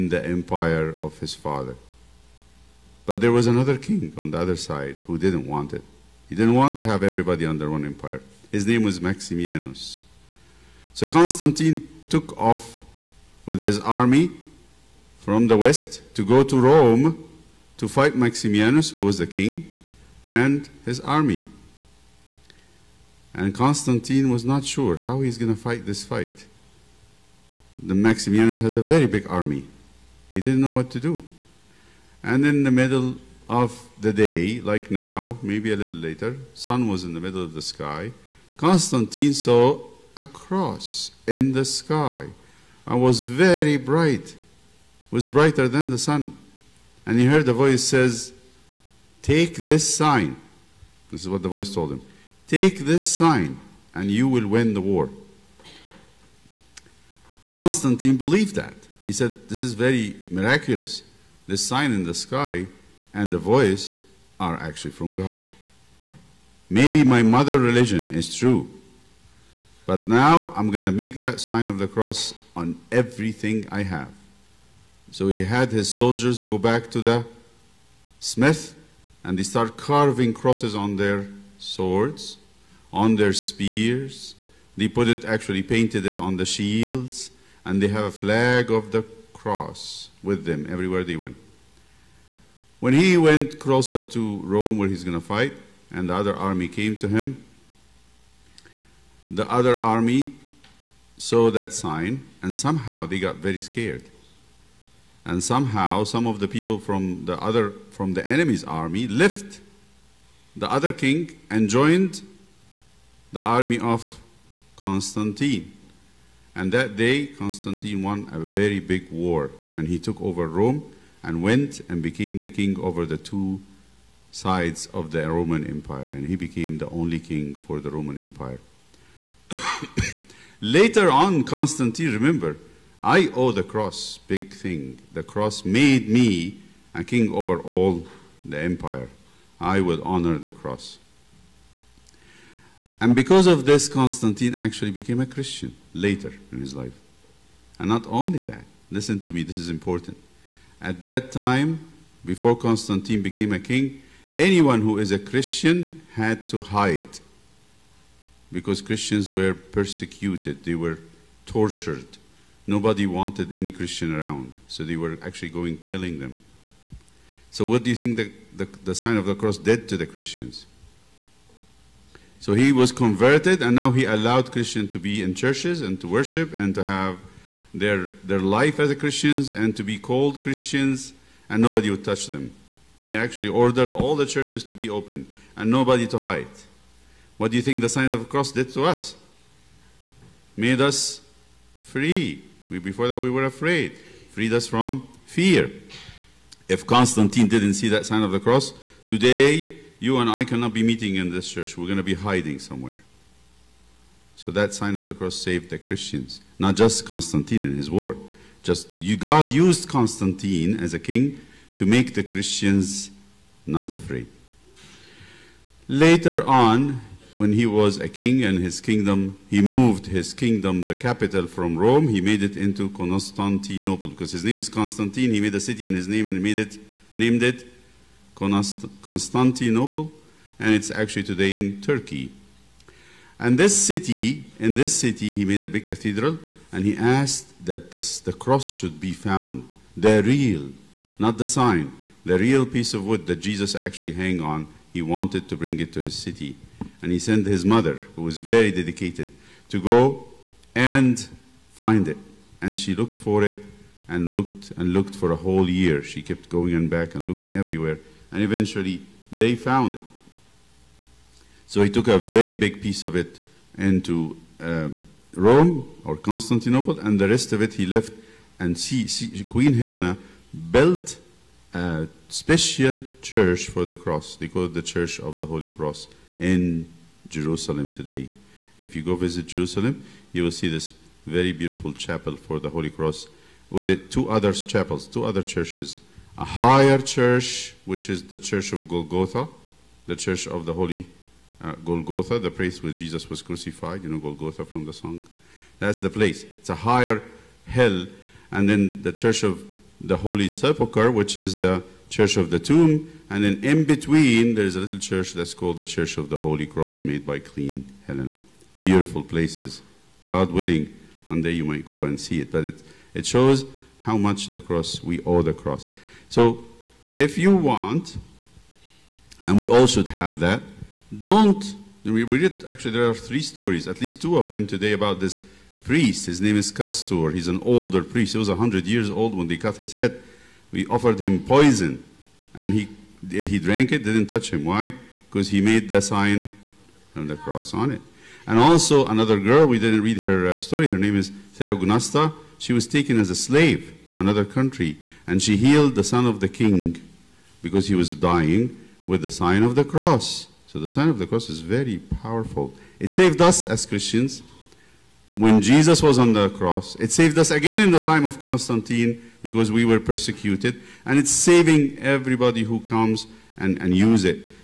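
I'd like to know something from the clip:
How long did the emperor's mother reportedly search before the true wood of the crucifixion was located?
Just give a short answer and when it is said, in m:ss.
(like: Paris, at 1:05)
A whole year, at 4:15.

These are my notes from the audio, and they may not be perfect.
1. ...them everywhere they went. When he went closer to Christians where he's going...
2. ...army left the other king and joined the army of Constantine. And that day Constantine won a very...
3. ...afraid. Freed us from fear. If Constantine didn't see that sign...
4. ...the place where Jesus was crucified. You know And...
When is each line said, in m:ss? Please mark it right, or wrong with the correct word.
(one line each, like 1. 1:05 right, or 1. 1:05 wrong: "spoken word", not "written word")
1. 1:30 wrong: "Rome", not "Christians"
2. 1:48 right
3. 3:13 right
4. 4:52 wrong: "Golgotha", not "And".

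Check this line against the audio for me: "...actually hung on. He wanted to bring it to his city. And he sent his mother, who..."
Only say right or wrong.
right.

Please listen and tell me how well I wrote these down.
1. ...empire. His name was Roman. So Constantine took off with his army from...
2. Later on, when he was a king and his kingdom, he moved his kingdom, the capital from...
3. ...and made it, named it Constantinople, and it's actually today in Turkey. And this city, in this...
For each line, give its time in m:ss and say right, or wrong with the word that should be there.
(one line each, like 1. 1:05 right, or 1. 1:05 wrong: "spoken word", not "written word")
1. 0:07 wrong: "Maximianus", not "Roman"
2. 3:35 right
3. 3:46 right.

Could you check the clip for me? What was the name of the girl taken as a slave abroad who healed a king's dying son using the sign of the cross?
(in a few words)
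Theognasta.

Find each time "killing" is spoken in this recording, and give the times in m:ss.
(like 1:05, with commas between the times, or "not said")
2:45.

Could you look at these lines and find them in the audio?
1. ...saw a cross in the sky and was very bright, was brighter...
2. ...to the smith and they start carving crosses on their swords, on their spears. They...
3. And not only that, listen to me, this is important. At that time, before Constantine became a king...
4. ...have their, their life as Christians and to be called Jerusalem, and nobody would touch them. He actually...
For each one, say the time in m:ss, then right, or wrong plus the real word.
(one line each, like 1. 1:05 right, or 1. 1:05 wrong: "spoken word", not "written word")
1. 0:39 right
2. 1:16 right
3. 2:27 right
4. 2:56 wrong: "Christians", not "Jerusalem".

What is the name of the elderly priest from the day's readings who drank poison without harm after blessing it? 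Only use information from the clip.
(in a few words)
Castor.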